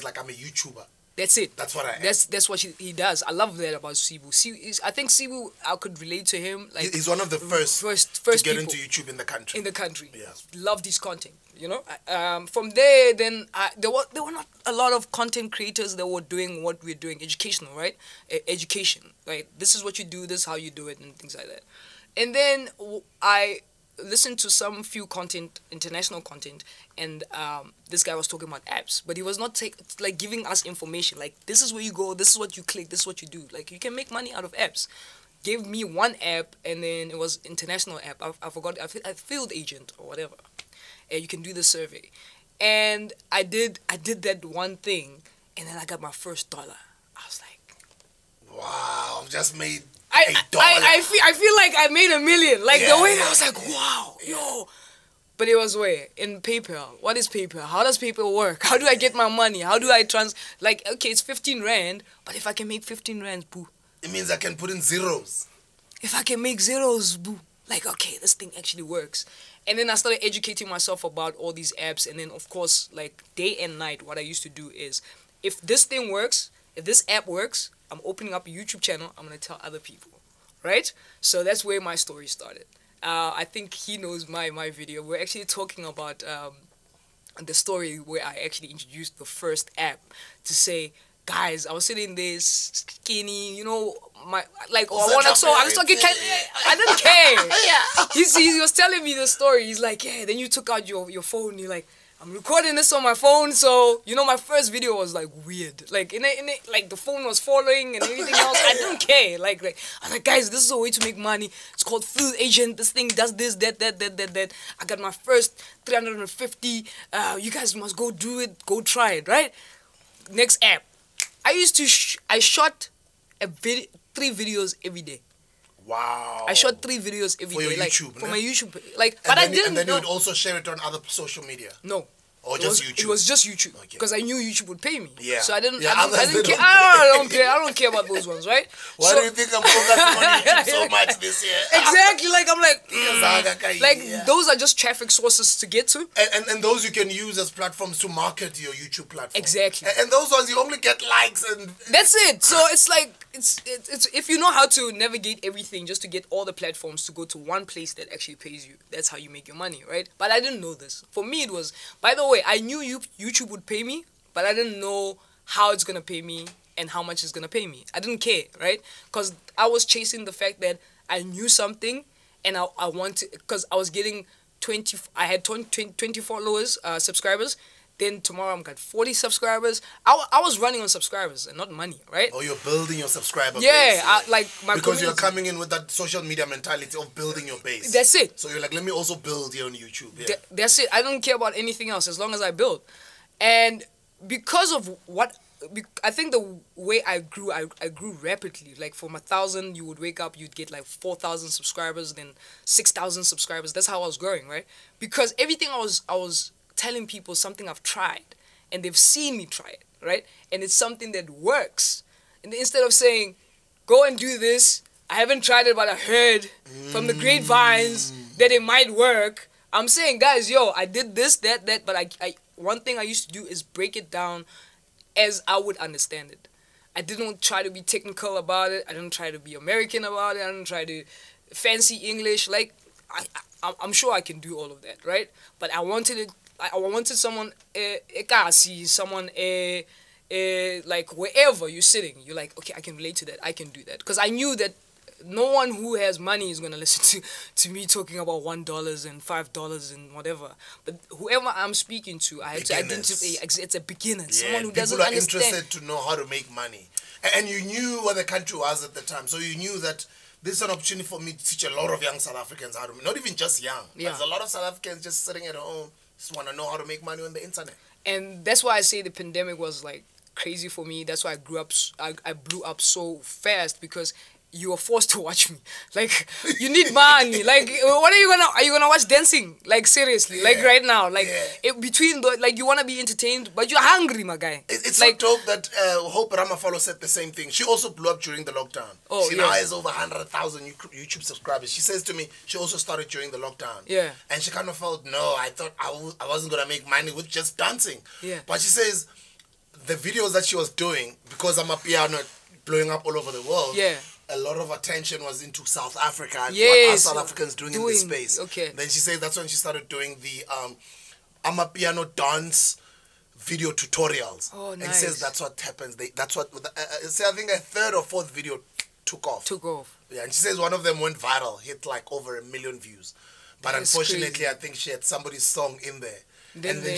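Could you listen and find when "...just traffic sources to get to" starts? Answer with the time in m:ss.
2:24.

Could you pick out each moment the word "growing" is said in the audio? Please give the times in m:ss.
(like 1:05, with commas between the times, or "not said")
3:24.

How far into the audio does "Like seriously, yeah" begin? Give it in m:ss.
4:39.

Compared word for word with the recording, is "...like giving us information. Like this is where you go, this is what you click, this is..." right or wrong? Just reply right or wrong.
right.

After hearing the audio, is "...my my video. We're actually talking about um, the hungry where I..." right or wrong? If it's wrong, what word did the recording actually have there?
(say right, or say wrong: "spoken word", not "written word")
wrong: "story", not "hungry".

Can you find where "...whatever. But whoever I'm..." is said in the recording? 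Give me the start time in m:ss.
4:10.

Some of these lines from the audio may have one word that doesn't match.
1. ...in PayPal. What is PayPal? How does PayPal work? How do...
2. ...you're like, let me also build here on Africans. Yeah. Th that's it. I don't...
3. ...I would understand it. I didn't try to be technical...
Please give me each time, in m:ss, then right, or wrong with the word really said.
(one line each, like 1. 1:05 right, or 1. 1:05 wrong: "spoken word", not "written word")
1. 0:56 right
2. 3:08 wrong: "YouTube", not "Africans"
3. 3:45 right.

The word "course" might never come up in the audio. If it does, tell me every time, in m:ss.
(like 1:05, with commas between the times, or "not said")
1:12.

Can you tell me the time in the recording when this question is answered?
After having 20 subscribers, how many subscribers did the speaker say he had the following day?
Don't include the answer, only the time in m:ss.
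2:58.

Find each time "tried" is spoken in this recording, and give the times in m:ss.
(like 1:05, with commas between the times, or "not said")
3:27, 3:35.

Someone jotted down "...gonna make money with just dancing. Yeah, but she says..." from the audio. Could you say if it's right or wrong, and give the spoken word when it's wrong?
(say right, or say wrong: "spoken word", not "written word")
right.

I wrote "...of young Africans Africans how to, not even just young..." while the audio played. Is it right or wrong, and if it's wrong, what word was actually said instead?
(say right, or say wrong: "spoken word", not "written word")
wrong: "South", not "Africans".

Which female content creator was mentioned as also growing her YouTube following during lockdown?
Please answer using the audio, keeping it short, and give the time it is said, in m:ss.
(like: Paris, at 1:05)
Hope Ramafalo, at 4:46.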